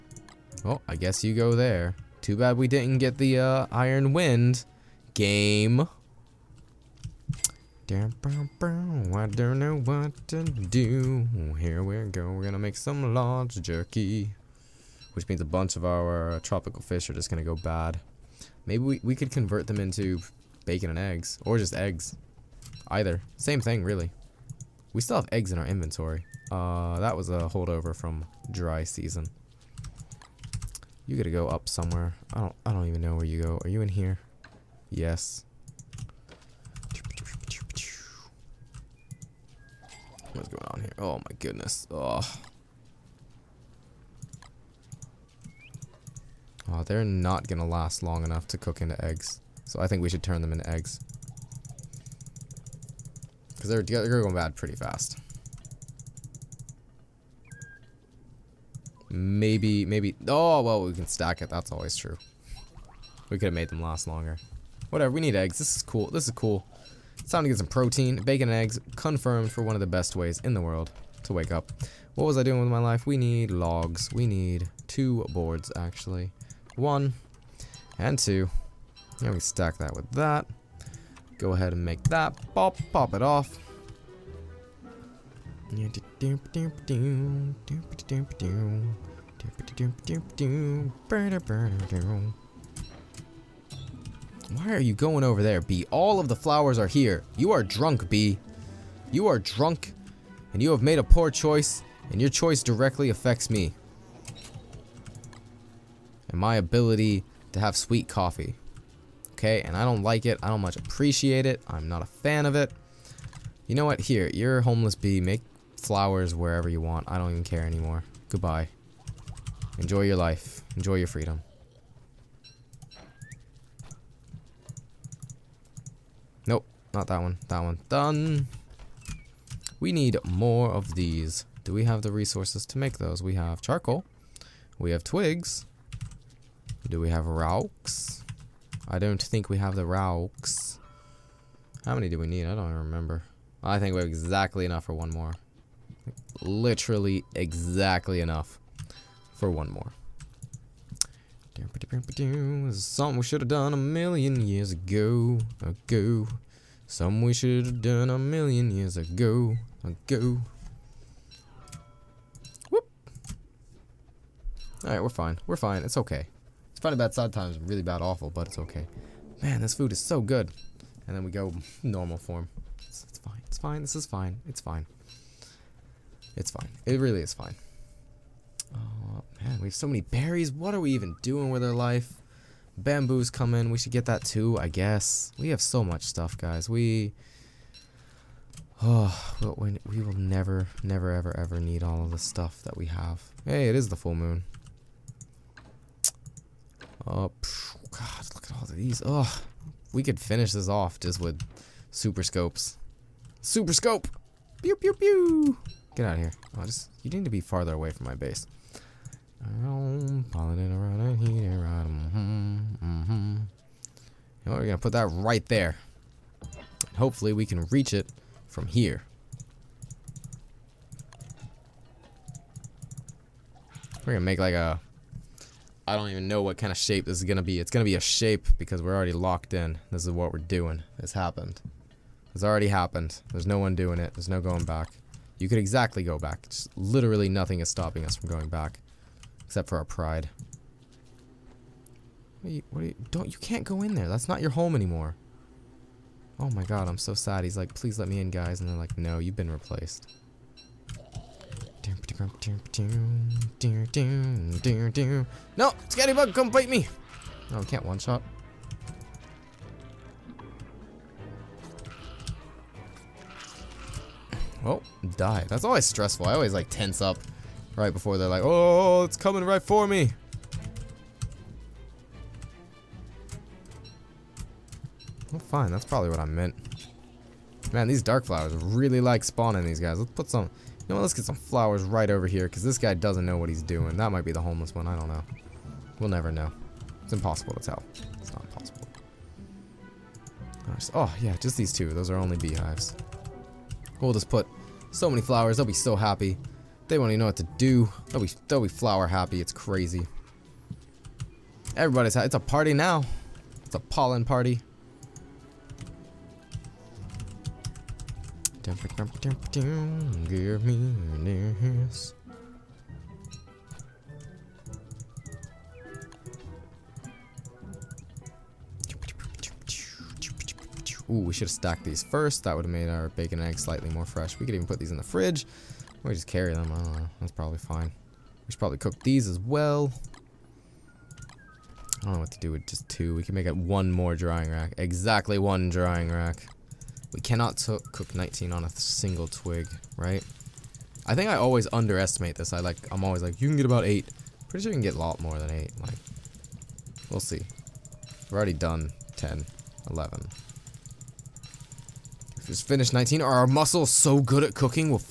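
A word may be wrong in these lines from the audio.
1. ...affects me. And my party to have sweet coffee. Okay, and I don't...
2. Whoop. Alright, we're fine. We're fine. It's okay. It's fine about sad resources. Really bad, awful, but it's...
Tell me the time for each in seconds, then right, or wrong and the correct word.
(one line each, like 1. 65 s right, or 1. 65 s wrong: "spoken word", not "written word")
1. 103 s wrong: "ability", not "party"
2. 162 s wrong: "times", not "resources".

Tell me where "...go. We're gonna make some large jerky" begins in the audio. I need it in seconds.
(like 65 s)
12 s.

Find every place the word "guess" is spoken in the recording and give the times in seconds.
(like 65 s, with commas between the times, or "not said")
0 s, 184 s.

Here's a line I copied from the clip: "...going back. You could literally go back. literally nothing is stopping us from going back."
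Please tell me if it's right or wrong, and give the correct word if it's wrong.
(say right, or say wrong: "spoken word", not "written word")
wrong: "exactly", not "literally".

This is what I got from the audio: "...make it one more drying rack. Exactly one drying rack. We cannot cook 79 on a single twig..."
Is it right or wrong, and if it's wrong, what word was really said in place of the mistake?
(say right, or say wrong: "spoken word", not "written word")
wrong: "19", not "79".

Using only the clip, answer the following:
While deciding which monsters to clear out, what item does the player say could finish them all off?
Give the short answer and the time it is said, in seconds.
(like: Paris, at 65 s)
super scopes, at 201 s.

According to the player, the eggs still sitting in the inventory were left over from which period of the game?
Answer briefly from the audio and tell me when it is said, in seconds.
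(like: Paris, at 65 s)
dry season, at 28 s.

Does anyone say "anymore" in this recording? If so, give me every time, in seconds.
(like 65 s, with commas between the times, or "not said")
117 s, 244 s.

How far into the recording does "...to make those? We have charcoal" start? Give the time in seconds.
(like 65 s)
132 s.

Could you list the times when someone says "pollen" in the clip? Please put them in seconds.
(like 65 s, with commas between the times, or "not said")
303 s.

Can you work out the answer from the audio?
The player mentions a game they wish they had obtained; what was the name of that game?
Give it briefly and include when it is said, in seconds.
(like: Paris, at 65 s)
Iron Wind, at 3 s.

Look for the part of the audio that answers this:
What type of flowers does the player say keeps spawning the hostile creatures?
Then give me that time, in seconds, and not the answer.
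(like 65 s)
278 s.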